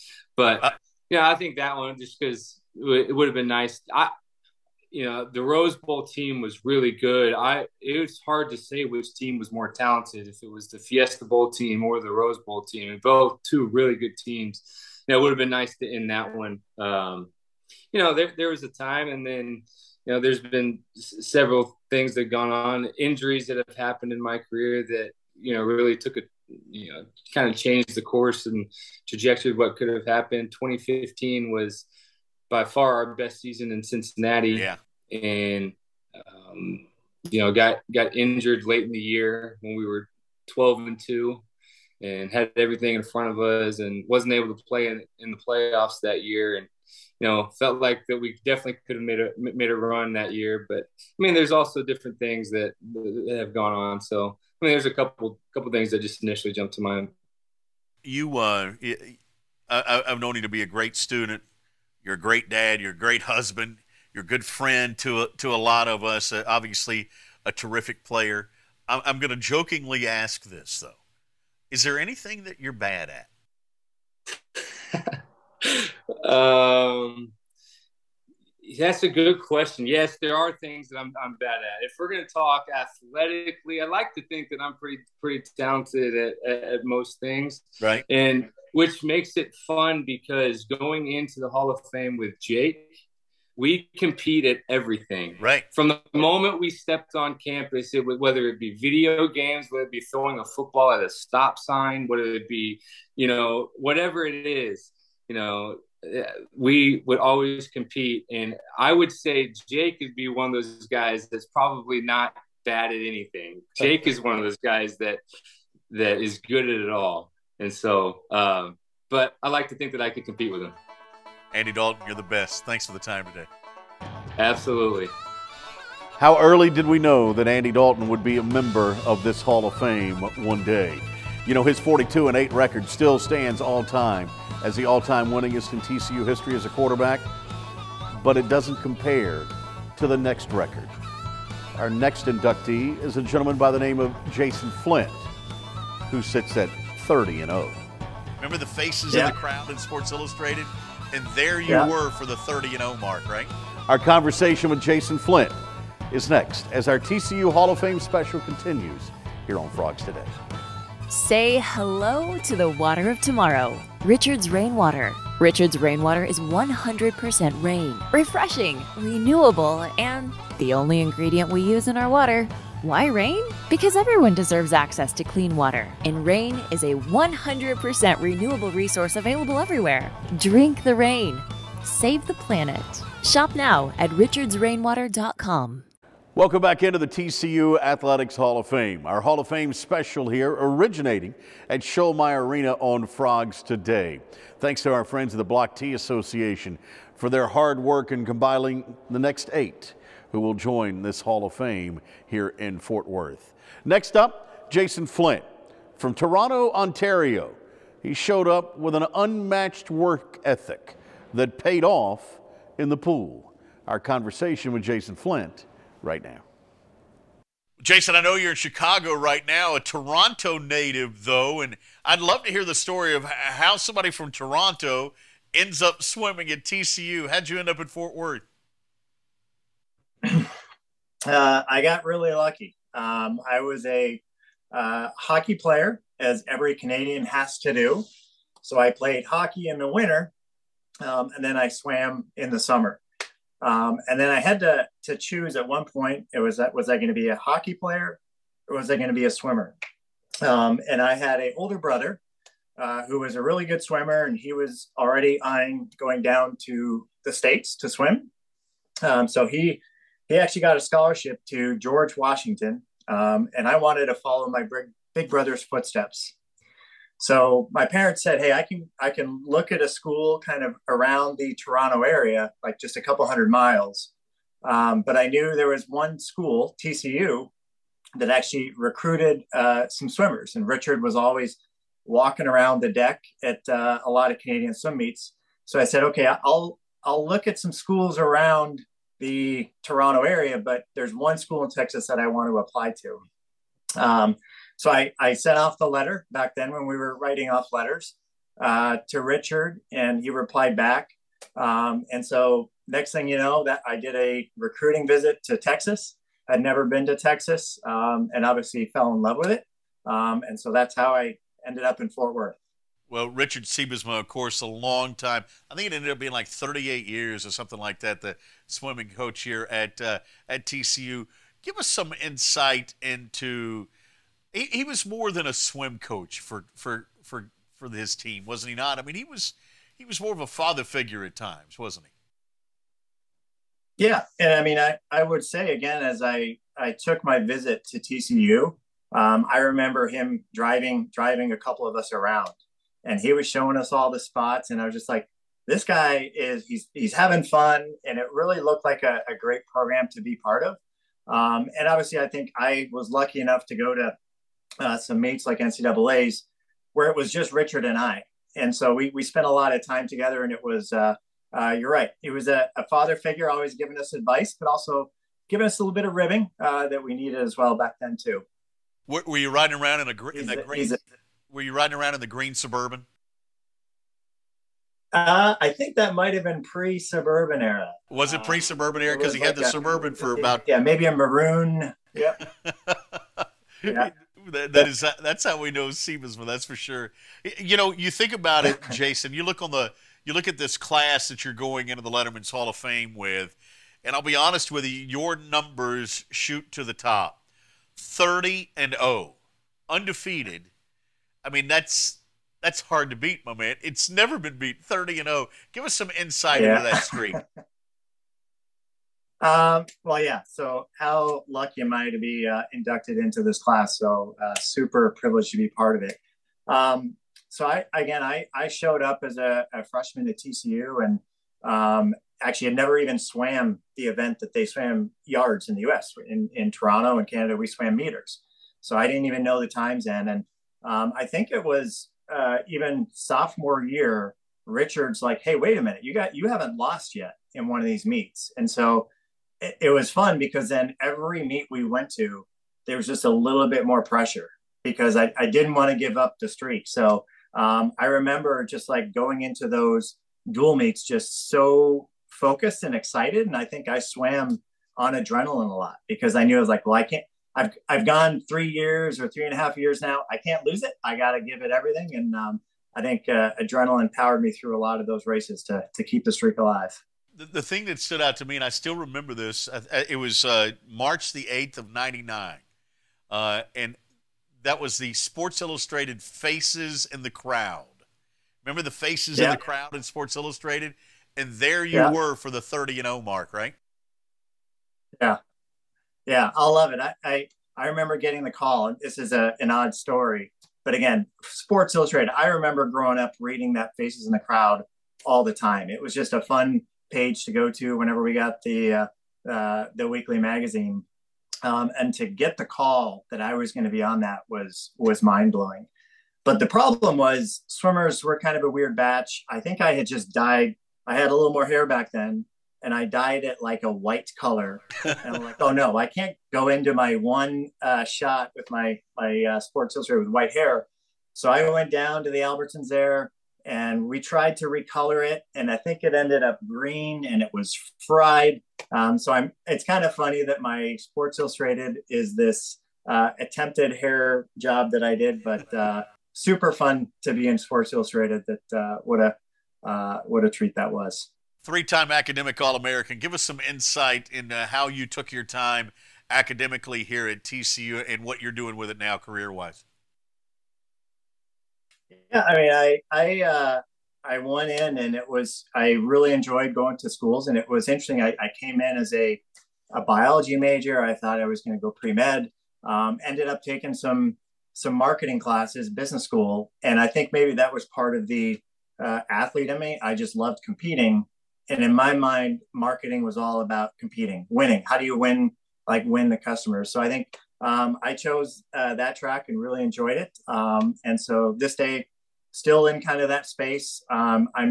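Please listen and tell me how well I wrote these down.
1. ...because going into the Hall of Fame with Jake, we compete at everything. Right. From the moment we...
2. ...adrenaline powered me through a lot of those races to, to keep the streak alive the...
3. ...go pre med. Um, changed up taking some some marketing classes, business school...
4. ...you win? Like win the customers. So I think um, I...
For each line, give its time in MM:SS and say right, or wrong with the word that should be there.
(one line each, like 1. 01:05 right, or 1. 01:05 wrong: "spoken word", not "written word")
1. 01:30 right
2. 07:43 right
3. 09:21 wrong: "ended", not "changed"
4. 09:35 right.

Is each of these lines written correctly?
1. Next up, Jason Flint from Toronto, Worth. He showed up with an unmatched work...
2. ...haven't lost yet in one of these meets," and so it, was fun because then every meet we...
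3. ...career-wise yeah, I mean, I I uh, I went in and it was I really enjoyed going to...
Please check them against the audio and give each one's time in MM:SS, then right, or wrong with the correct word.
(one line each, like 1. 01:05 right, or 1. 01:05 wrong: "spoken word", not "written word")
1. 03:23 wrong: "Ontario", not "Worth"
2. 07:16 right
3. 09:09 right.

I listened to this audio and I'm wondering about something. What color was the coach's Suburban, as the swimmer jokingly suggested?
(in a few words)
maroon.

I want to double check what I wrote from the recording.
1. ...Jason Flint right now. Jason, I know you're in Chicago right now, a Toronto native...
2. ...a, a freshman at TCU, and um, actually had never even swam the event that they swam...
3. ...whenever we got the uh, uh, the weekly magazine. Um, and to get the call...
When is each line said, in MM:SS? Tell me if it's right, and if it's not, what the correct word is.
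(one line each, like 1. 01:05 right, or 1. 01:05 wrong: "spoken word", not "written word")
1. 03:34 right
2. 06:59 right
3. 08:17 right.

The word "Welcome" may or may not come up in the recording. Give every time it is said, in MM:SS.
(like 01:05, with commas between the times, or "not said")
03:06.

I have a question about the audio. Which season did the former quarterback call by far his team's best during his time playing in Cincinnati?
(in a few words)
2015.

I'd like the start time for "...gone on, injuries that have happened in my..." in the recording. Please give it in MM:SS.
00:22.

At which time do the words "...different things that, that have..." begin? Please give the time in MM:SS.
00:51.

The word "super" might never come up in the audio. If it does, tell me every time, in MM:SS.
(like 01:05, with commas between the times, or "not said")
06:54, 08:56.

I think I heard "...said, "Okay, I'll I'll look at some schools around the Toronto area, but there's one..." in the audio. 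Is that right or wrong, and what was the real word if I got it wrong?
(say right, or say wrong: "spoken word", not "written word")
right.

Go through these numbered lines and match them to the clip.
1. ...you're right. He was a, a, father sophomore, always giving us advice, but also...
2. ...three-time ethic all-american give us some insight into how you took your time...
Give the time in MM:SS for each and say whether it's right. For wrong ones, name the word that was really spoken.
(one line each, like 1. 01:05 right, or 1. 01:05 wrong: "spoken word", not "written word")
1. 06:01 wrong: "figure", not "sophomore"
2. 09:01 wrong: "academic", not "ethic".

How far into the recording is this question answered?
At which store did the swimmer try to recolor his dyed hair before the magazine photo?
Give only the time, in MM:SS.
08:42.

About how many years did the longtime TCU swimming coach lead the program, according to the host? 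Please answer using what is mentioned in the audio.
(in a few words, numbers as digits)
38.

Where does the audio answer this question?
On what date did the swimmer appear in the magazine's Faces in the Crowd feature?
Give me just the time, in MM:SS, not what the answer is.
07:50.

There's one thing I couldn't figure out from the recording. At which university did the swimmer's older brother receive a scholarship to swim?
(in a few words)
George Washington.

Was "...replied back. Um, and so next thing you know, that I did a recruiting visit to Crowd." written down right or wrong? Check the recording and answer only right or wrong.
wrong.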